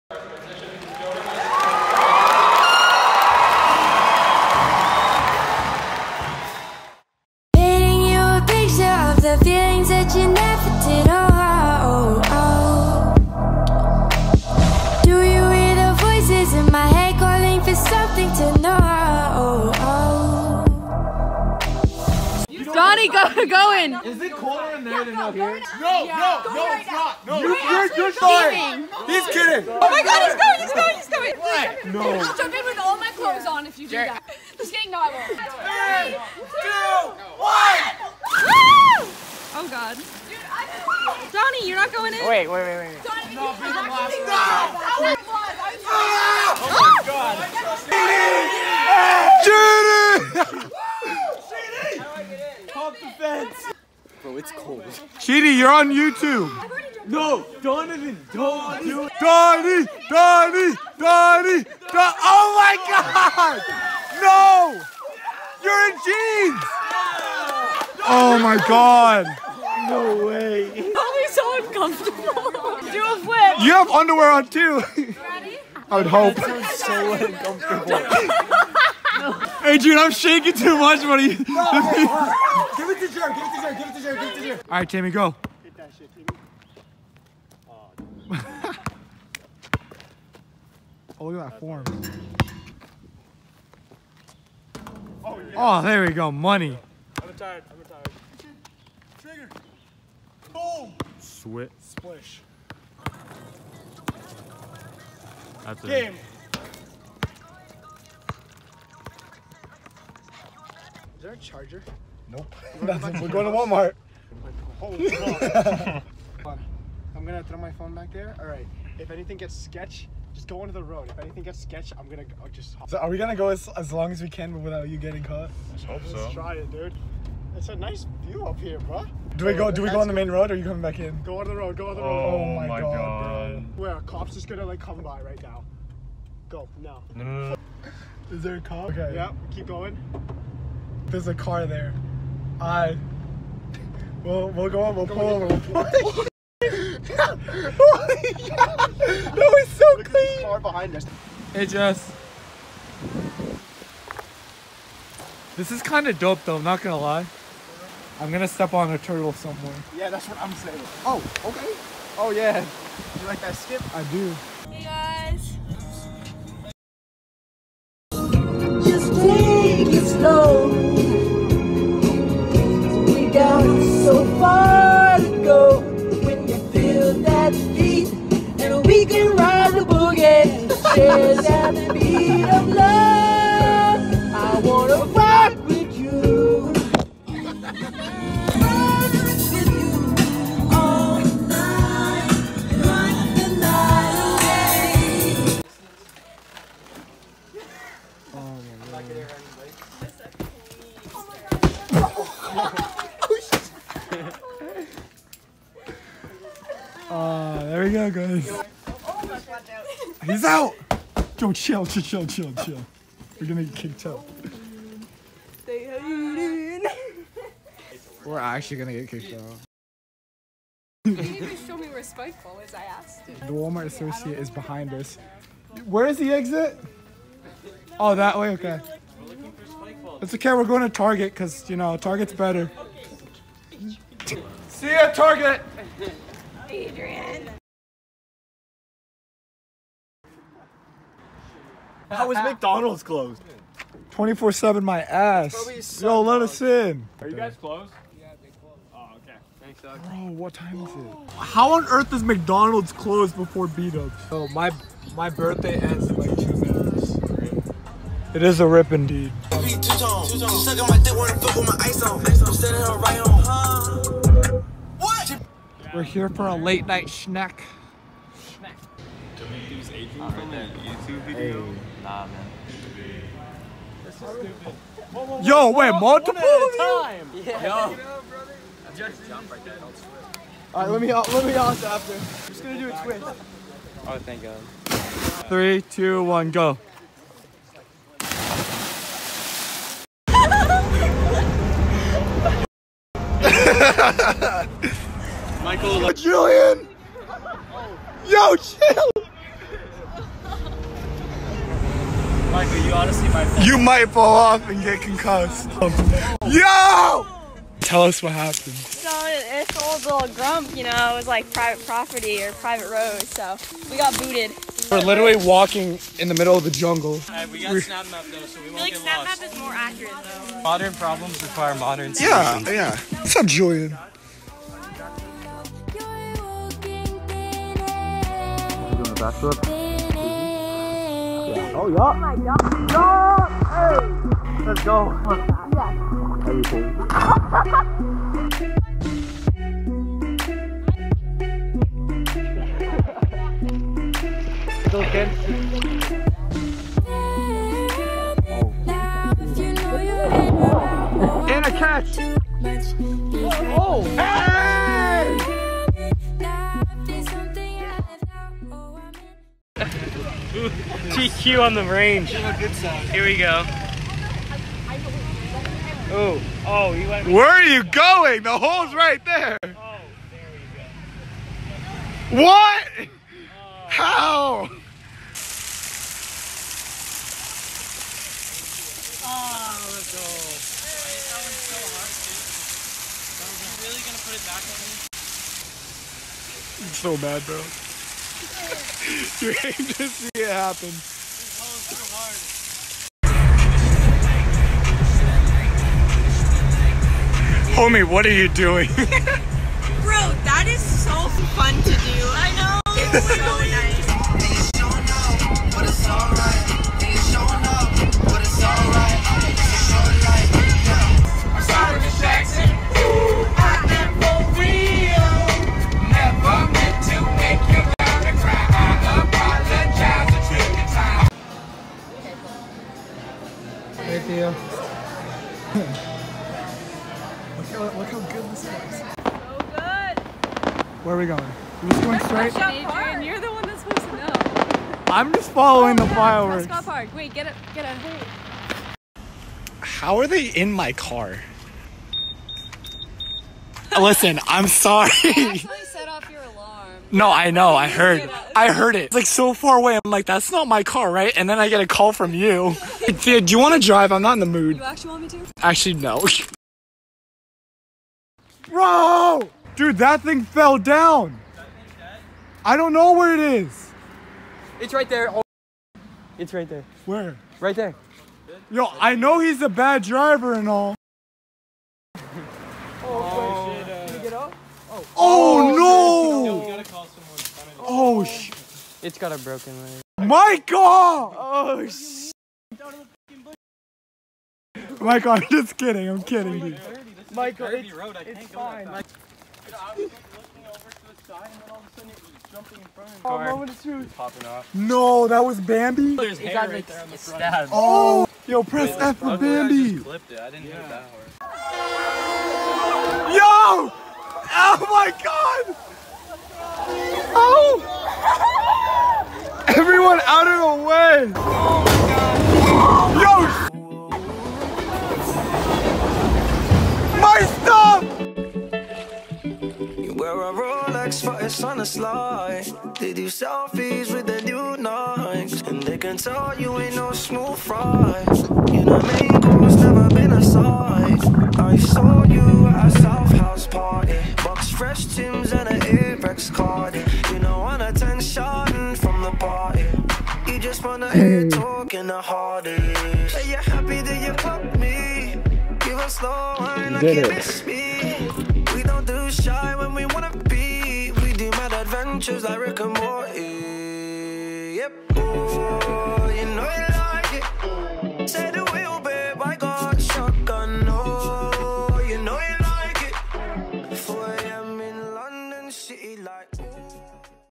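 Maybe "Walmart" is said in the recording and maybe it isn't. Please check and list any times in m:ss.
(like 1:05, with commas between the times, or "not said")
1:53, 3:43.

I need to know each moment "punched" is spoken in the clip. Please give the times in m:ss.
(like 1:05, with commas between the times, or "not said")
not said.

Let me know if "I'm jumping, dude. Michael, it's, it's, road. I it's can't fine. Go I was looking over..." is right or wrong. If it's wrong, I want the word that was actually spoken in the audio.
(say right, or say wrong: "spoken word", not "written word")
wrong: "kidding", not "jumping".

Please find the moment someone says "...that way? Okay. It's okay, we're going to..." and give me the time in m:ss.
3:48.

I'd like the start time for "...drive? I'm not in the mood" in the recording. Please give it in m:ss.
7:33.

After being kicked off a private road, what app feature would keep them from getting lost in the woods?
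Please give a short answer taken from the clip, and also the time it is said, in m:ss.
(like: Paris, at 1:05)
Snap Map, at 5:17.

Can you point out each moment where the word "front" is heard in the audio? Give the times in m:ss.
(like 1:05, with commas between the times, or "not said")
8:12, 8:17.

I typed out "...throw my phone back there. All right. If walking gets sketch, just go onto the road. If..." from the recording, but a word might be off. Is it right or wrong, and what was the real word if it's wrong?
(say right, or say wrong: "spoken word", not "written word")
wrong: "anything", not "walking".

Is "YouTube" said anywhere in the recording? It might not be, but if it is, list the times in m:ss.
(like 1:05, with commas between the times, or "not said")
0:55, 4:30.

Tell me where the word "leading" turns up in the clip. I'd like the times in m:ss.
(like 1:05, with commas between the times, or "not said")
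not said.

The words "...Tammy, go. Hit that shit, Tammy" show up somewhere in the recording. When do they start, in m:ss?
1:24.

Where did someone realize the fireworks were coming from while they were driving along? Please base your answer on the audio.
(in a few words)
Prescott Park.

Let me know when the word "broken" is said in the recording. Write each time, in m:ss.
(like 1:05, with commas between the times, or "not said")
7:59.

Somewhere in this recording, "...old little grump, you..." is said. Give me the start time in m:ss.
5:09.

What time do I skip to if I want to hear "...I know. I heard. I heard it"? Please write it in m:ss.
7:27.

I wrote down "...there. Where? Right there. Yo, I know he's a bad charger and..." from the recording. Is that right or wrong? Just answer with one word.
wrong.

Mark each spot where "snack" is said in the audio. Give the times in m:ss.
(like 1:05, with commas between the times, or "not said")
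4:27.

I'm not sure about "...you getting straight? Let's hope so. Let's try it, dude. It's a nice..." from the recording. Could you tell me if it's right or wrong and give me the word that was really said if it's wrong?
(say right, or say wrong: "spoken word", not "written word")
wrong: "caught", not "straight".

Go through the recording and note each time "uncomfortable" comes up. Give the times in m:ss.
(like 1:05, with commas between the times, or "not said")
1:11, 1:17.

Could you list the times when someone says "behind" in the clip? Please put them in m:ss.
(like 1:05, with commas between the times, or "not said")
2:30, 3:44.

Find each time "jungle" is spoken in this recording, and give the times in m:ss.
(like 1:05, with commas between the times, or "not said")
5:16.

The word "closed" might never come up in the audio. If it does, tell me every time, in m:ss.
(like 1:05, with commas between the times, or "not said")
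4:03, 4:07, 4:12.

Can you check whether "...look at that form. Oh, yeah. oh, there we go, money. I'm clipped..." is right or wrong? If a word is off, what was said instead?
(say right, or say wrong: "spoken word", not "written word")
wrong: "retired", not "clipped".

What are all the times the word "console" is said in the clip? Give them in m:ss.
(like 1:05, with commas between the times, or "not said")
not said.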